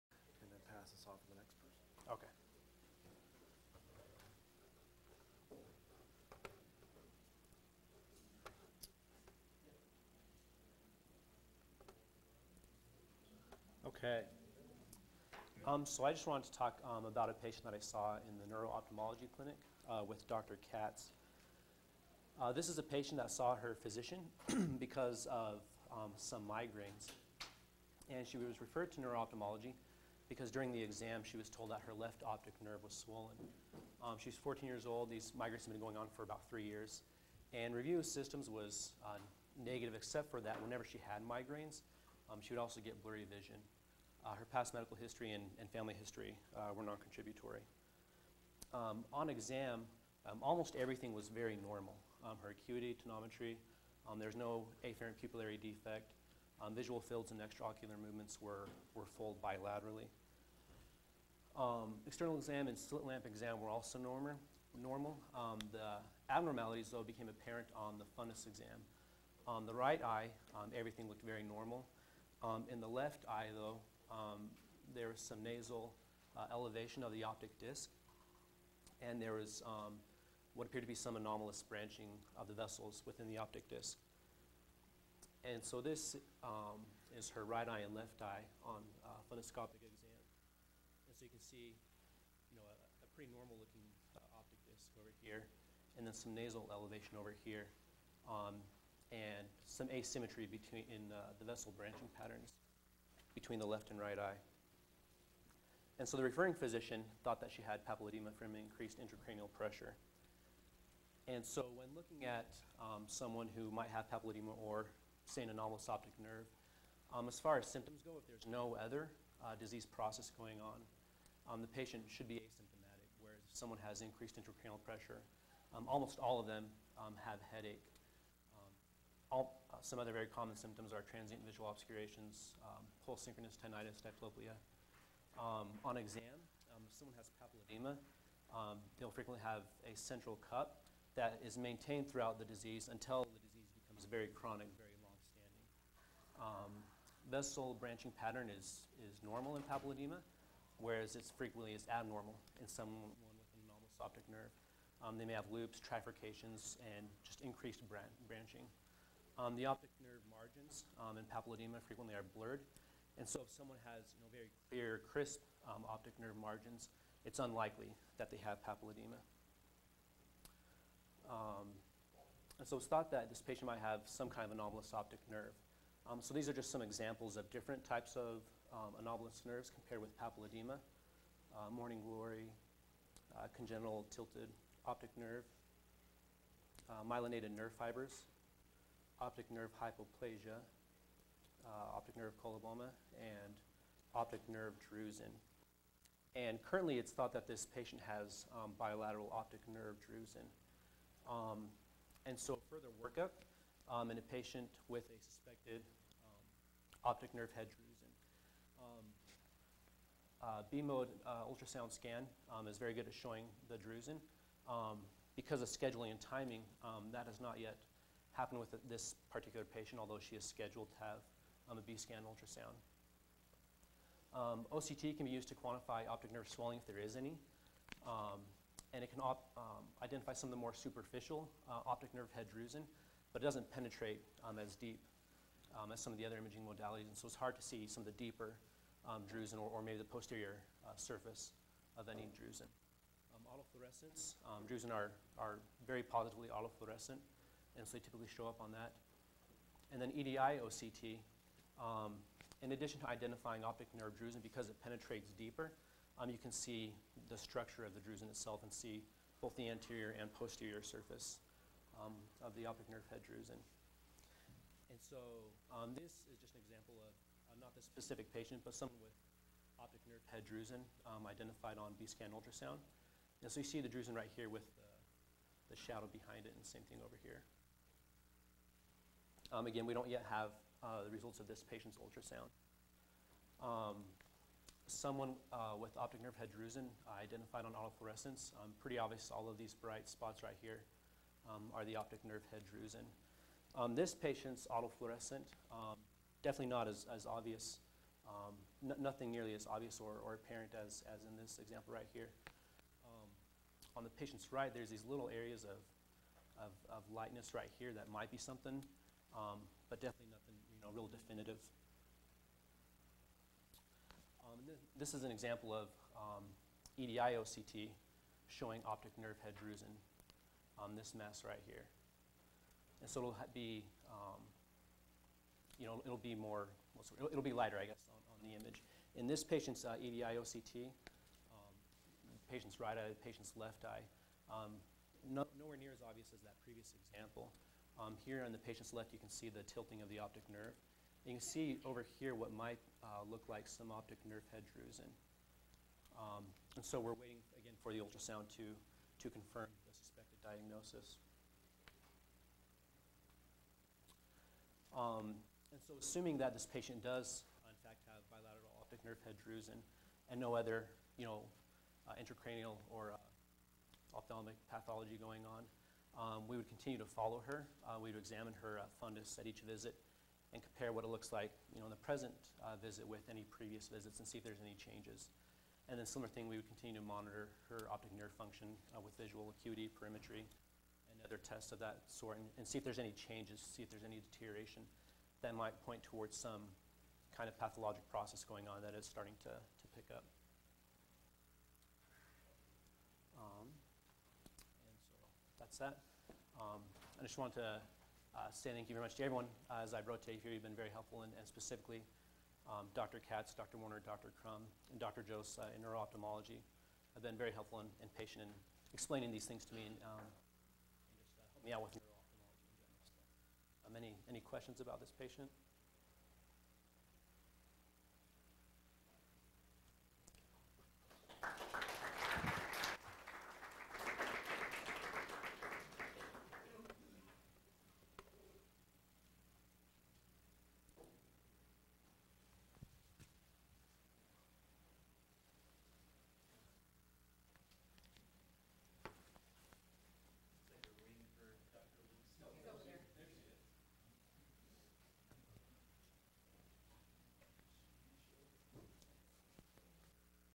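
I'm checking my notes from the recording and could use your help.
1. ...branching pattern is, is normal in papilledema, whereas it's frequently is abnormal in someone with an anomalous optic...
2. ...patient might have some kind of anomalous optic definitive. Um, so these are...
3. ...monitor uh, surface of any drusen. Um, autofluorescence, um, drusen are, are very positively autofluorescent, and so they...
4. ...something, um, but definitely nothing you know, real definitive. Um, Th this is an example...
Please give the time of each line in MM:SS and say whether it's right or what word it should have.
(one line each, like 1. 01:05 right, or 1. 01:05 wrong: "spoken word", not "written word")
1. 02:27 right
2. 02:53 wrong: "nerve", not "definitive"
3. 04:00 wrong: "posterior", not "monitor"
4. 05:08 right.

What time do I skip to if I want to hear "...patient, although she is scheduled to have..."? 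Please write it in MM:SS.
03:39.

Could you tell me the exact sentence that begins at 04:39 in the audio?
Um, again, we don't yet have uh, the results of this patient's ultrasound.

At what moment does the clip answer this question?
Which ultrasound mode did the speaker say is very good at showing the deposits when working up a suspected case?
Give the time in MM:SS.
03:30.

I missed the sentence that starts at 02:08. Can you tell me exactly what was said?
Um, all, uh, some other very common symptoms are transient visual obscurations, um, pulse synchronous tinnitus, diplopia.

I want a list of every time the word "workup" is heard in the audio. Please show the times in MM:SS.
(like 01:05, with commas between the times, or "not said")
03:23.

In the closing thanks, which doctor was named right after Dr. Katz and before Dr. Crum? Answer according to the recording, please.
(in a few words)
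Dr. Warner.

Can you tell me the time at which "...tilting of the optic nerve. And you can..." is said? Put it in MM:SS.
05:39.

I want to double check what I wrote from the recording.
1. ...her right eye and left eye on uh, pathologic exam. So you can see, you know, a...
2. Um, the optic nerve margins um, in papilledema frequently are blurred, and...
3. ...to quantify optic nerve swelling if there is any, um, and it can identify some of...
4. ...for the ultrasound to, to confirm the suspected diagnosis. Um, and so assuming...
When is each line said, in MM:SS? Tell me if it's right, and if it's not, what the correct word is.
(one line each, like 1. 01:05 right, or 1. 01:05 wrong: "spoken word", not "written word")
1. 01:27 wrong: "fundoscopic", not "pathologic"
2. 02:39 right
3. 03:45 right
4. 05:47 right.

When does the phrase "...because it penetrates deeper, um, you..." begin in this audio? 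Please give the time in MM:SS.
04:14.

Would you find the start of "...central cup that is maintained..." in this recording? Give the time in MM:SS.
02:19.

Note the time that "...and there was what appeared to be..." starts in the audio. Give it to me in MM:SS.
01:19.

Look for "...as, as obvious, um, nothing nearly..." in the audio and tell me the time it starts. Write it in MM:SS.
04:56.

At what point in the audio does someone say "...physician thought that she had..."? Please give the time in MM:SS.
01:46.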